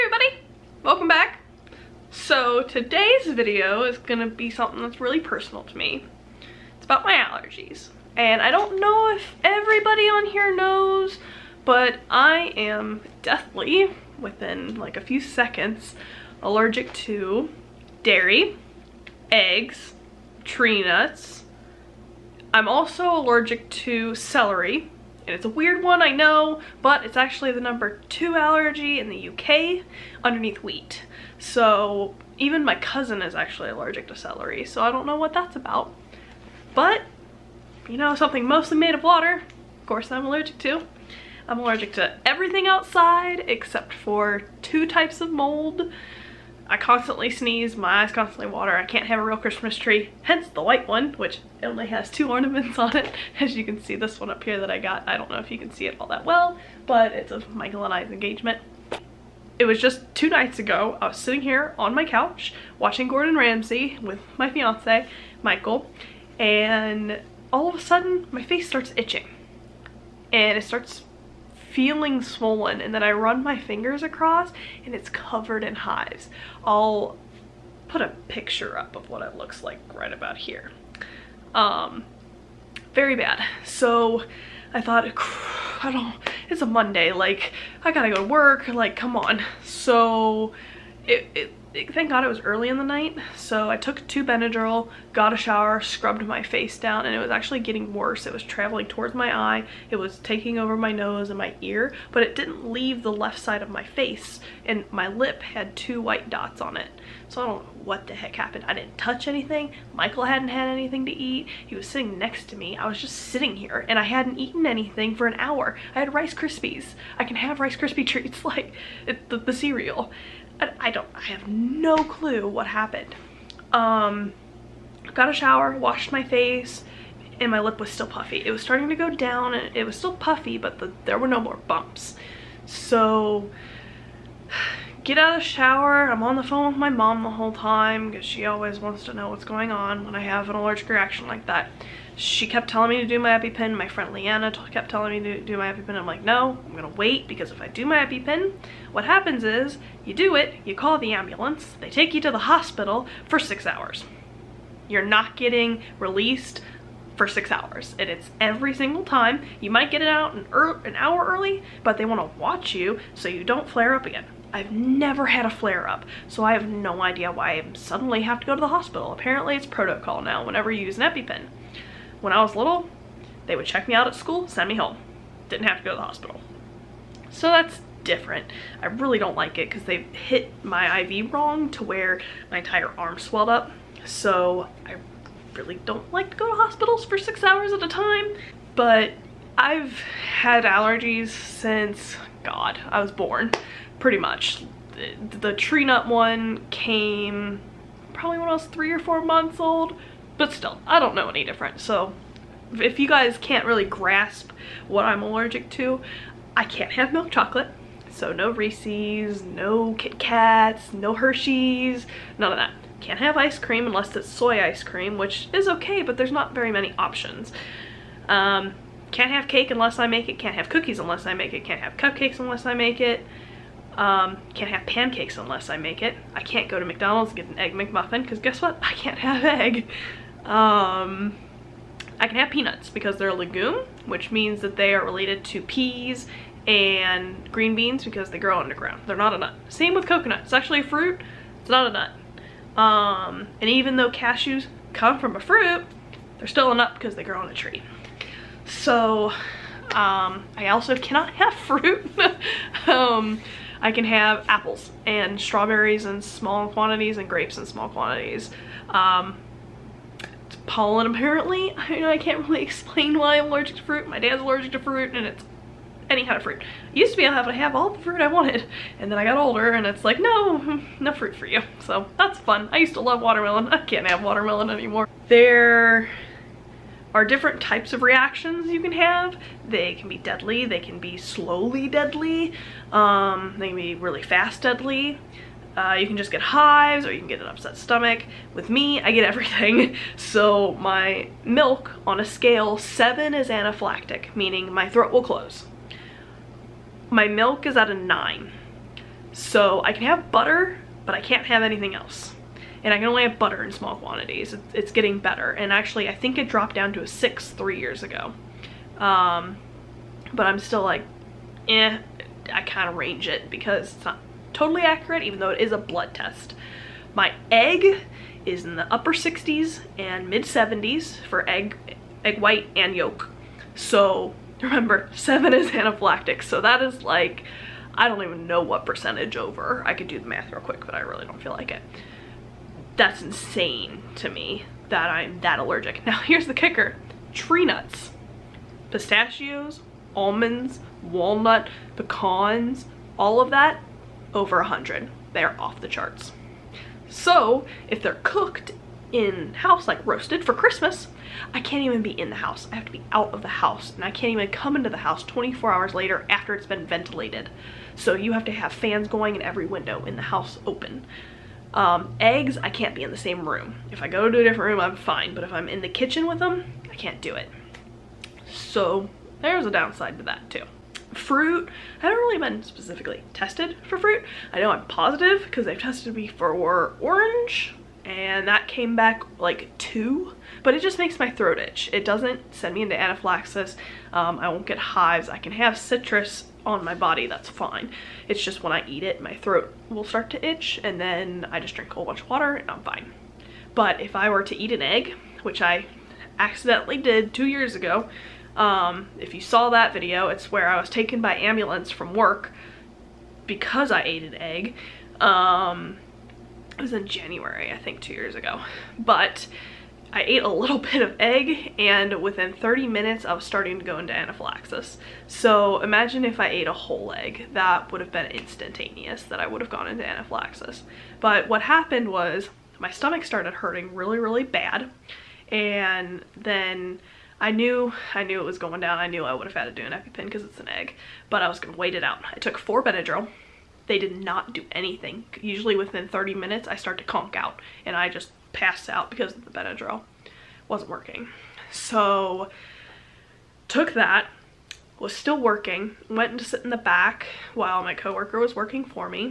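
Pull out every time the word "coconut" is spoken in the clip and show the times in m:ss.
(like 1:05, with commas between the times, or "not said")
4:00.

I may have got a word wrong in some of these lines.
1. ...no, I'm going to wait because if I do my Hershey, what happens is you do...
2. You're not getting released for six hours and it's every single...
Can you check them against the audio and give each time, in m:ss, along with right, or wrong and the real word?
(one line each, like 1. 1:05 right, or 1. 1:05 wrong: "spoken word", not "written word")
1. 2:26 wrong: "EpiPen", not "Hershey"
2. 2:34 right.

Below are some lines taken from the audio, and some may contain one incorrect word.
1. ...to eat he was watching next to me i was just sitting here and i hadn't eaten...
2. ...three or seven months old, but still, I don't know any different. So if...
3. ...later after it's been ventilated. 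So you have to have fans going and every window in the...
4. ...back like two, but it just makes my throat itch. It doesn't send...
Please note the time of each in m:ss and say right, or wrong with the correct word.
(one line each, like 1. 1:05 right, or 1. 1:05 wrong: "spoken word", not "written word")
1. 1:51 wrong: "sitting", not "watching"
2. 3:18 wrong: "four", not "seven"
3. 5:55 right
4. 6:18 right.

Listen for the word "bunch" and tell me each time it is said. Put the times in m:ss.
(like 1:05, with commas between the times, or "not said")
6:32.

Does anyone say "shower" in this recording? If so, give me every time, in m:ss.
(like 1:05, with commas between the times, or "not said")
1:35, 2:05, 2:15.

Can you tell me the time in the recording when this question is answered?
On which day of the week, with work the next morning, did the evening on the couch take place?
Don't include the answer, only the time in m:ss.
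1:26.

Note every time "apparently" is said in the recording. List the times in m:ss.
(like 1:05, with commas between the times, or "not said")
2:49, 4:21.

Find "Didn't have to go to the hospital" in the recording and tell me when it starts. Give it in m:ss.
2:55.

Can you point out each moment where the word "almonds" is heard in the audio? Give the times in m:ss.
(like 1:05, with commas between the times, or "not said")
5:40.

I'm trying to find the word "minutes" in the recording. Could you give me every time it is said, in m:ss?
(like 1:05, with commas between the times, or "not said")
6:52, 7:16.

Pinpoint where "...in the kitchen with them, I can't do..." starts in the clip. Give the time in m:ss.
6:05.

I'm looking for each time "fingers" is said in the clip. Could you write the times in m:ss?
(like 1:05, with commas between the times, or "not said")
1:13.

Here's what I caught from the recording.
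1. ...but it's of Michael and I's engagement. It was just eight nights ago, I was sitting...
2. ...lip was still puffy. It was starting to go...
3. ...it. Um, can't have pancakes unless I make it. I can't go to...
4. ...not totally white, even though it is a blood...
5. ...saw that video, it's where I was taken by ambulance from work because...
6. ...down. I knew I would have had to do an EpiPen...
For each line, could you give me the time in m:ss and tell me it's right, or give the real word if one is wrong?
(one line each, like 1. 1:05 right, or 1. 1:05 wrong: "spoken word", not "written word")
1. 0:56 wrong: "two", not "eight"
2. 2:07 right
3. 3:42 right
4. 5:14 wrong: "accurate", not "white"
5. 6:39 right
6. 7:08 right.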